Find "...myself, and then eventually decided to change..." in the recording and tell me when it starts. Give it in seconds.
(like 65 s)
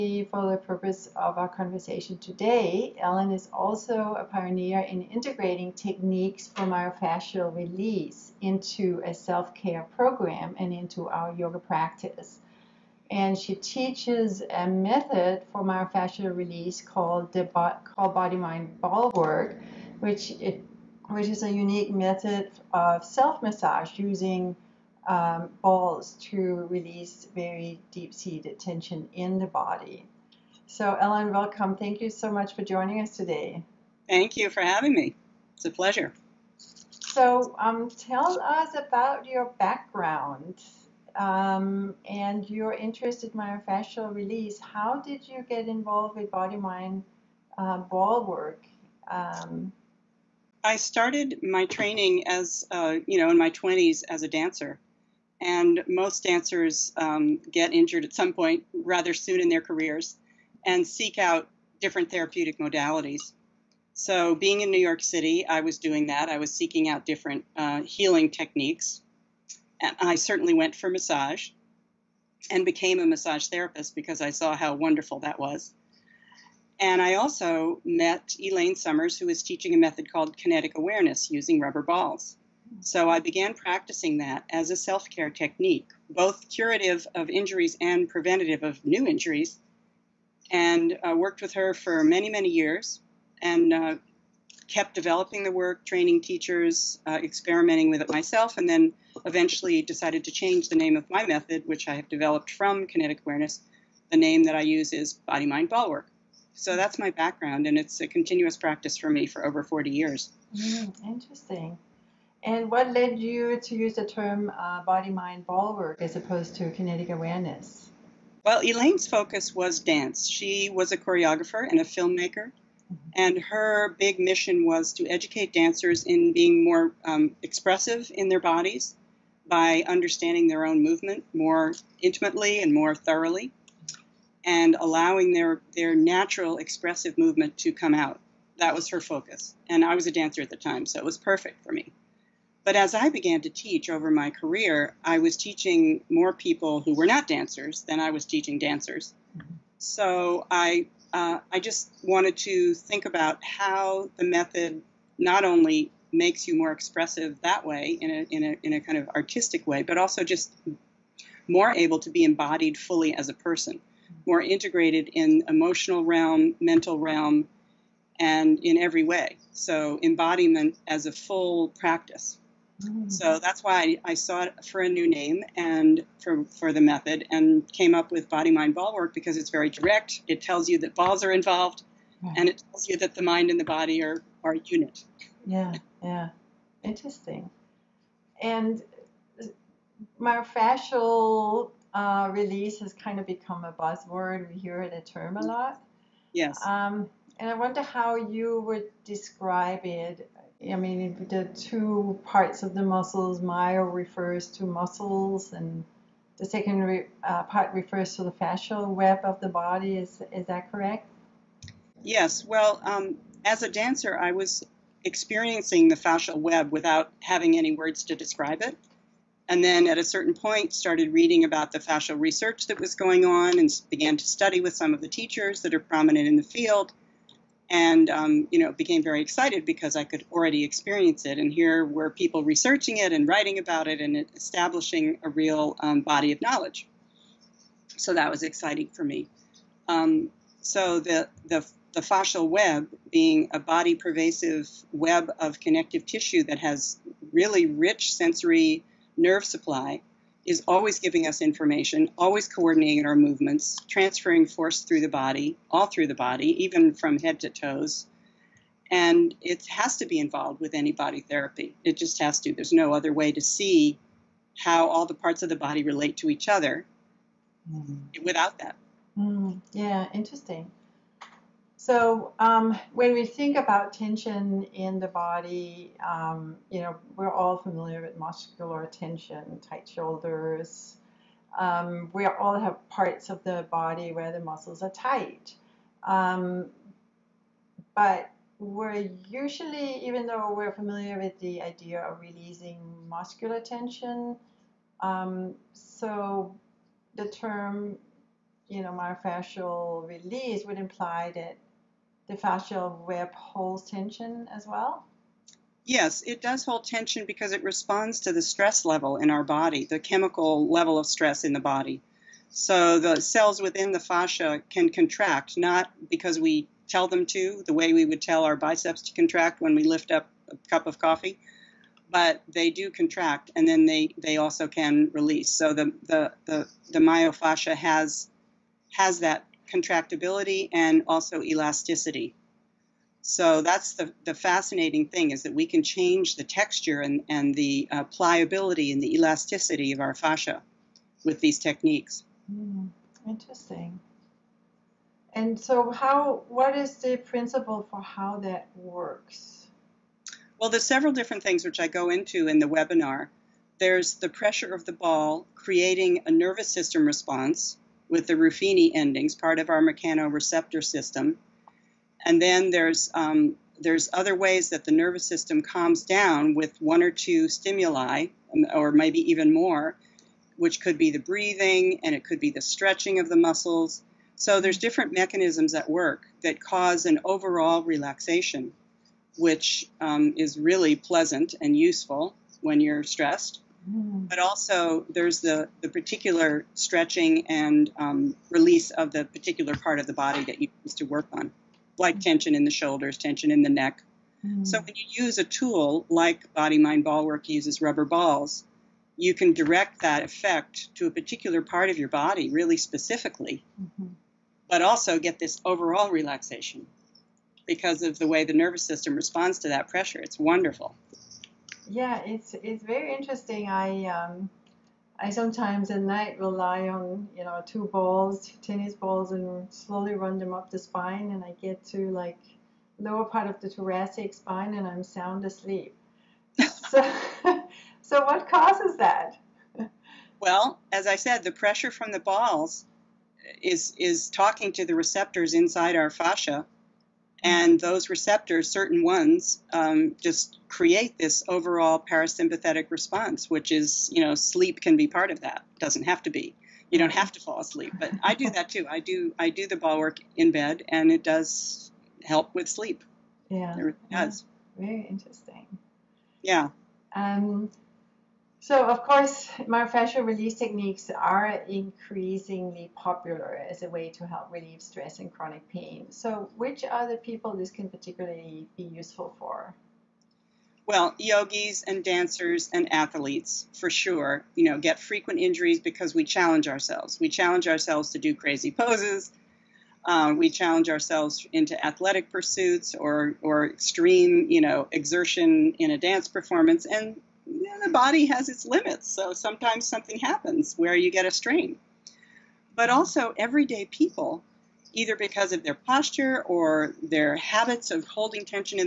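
98 s.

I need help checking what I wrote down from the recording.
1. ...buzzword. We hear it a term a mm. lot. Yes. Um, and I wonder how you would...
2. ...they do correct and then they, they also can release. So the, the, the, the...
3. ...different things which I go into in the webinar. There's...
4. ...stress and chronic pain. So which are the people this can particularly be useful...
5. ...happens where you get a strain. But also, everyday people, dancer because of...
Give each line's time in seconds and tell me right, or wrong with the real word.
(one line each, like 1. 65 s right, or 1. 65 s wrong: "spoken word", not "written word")
1. 193 s right
2. 322 s wrong: "contract", not "correct"
3. 351 s right
4. 464 s right
5. 490 s wrong: "either", not "dancer".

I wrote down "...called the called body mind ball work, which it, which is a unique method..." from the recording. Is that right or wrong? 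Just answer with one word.
right.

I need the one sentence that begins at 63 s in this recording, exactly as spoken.
So, being in New York City, I was doing that.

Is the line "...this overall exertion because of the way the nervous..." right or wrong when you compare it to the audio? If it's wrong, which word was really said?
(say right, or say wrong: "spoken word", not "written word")
wrong: "relaxation", not "exertion".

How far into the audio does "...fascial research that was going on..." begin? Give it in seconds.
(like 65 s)
221 s.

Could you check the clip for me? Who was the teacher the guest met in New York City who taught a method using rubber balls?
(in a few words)
Elaine Summers.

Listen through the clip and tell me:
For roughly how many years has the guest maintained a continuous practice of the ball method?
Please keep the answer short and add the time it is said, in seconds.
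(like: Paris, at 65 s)
40, at 109 s.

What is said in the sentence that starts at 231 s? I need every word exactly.
And here were people researching it and writing about it and establishing a real um, body of knowledge.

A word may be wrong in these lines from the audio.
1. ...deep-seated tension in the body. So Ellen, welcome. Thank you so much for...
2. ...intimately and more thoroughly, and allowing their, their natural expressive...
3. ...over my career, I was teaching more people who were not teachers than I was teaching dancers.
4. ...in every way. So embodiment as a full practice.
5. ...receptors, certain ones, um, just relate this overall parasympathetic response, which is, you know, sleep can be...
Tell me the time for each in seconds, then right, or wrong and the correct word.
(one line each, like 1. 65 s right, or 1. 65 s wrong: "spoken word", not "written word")
1. 27 s right
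2. 132 s right
3. 143 s wrong: "dancers", not "teachers"
4. 168 s right
5. 438 s wrong: "create", not "relate".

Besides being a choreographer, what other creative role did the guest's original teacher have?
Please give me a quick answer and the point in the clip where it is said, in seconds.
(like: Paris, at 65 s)
filmmaker, at 121 s.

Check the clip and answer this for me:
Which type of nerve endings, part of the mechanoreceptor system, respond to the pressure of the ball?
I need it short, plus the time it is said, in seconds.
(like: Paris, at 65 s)
Ruffini endings, at 358 s.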